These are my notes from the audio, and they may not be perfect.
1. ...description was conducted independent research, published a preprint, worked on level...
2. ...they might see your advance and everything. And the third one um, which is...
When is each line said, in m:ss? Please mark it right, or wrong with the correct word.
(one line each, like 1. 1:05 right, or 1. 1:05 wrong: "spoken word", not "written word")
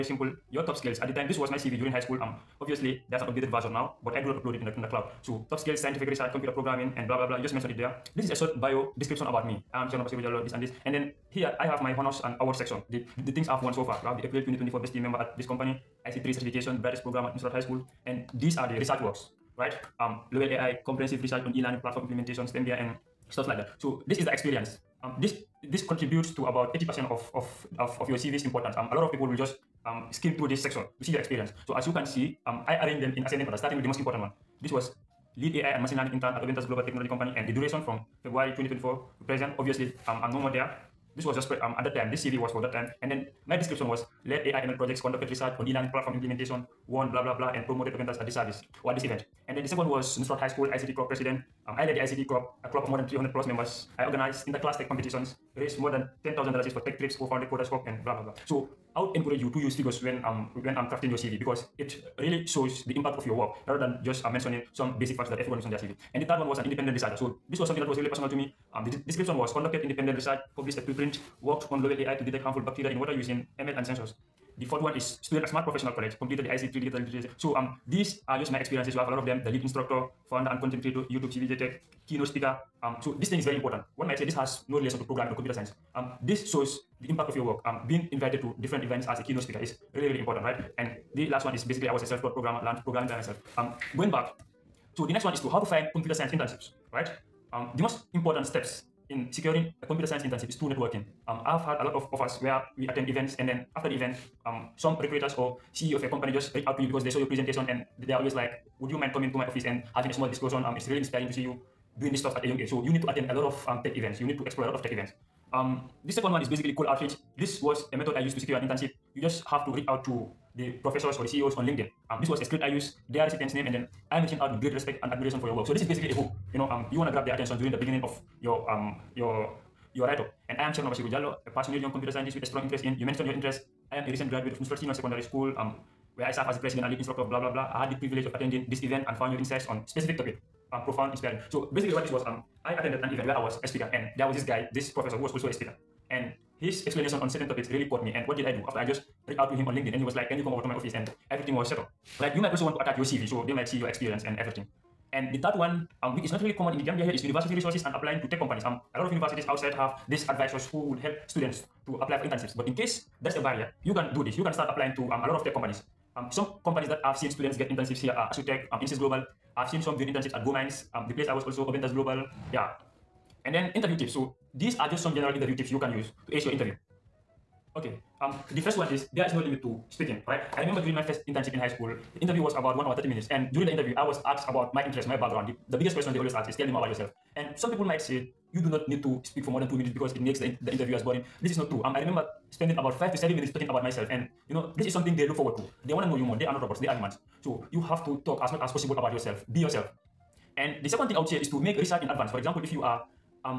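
1. 1:09 right
2. 2:33 wrong: "experience", not "advance".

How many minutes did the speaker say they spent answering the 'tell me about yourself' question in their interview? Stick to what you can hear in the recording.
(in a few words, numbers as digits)
5 to 7 minutes.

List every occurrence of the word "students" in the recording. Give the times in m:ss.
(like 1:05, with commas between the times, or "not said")
1:15, 2:41, 2:47.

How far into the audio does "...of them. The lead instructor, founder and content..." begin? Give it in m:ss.
1:19.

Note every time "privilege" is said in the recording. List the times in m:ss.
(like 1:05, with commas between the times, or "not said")
2:18.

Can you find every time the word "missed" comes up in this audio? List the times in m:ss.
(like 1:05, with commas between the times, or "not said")
not said.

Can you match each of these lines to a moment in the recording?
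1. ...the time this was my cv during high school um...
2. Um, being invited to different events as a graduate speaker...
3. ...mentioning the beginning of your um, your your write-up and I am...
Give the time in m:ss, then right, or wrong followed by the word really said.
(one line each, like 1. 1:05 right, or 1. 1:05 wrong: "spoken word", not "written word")
1. 0:01 right
2. 1:27 wrong: "keynote", not "graduate"
3. 2:07 wrong: "during", not "mentioning".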